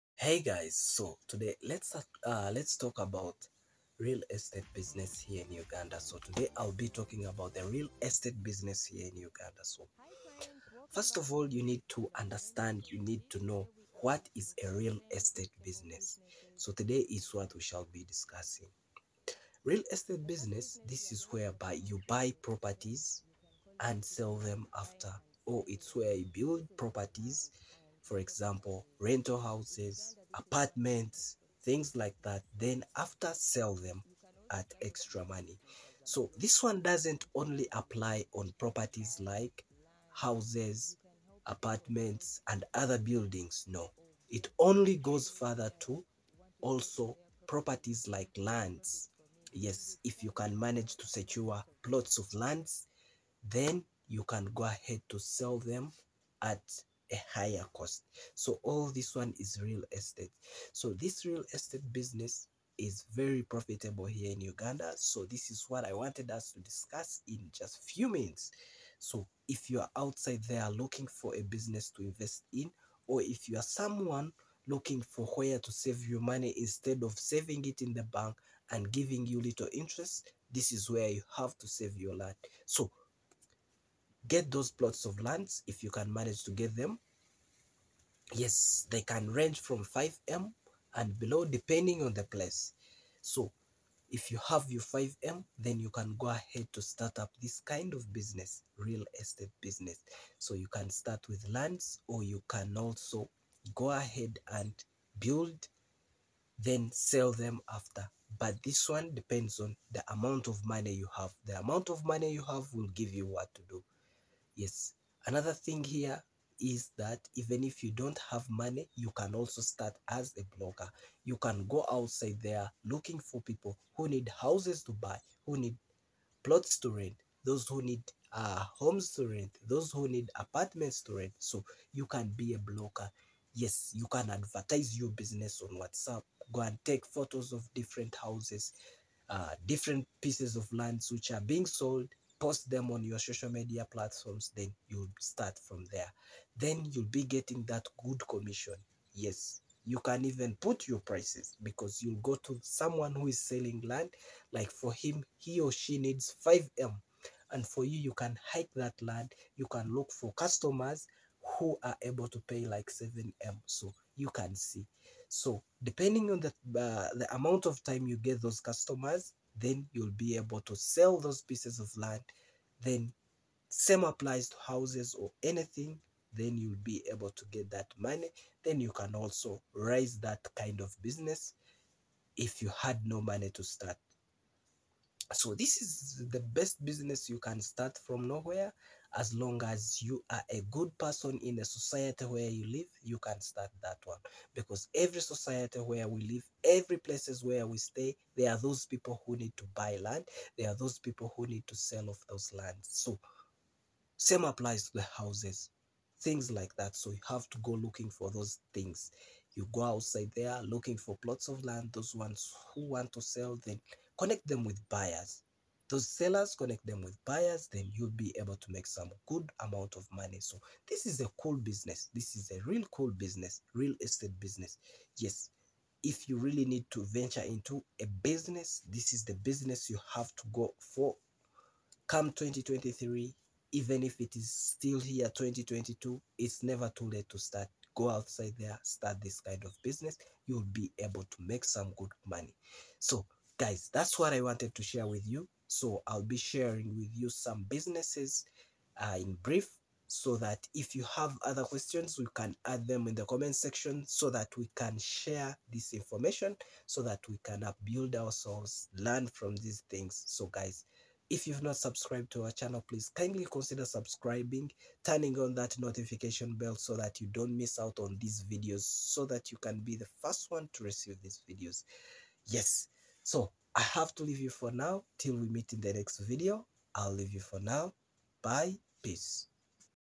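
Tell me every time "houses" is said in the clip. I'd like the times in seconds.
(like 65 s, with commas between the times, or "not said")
29 s, 40 s, 124 s, 138 s, 174 s, 205 s.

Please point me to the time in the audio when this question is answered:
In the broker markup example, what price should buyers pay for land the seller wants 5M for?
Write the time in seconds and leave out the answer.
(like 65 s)
162 s.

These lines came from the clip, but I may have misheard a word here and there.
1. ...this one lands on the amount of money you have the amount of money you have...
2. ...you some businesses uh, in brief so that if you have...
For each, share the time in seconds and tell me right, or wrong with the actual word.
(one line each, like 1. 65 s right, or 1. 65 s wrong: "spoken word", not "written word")
1. 108 s wrong: "depends", not "lands"
2. 247 s right.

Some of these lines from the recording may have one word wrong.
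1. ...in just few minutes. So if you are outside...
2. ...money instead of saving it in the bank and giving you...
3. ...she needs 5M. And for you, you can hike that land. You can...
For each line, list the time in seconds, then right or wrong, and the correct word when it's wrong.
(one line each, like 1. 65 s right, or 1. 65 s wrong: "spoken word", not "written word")
1. 67 s right
2. 76 s right
3. 155 s right.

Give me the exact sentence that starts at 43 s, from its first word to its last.
No, it only goes further to also properties like lands.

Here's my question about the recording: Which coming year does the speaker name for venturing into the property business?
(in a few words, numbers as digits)
2023.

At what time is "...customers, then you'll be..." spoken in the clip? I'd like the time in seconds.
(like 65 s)
168 s.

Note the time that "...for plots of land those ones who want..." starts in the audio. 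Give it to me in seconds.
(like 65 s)
210 s.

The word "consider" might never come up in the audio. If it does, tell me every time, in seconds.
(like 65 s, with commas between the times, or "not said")
263 s.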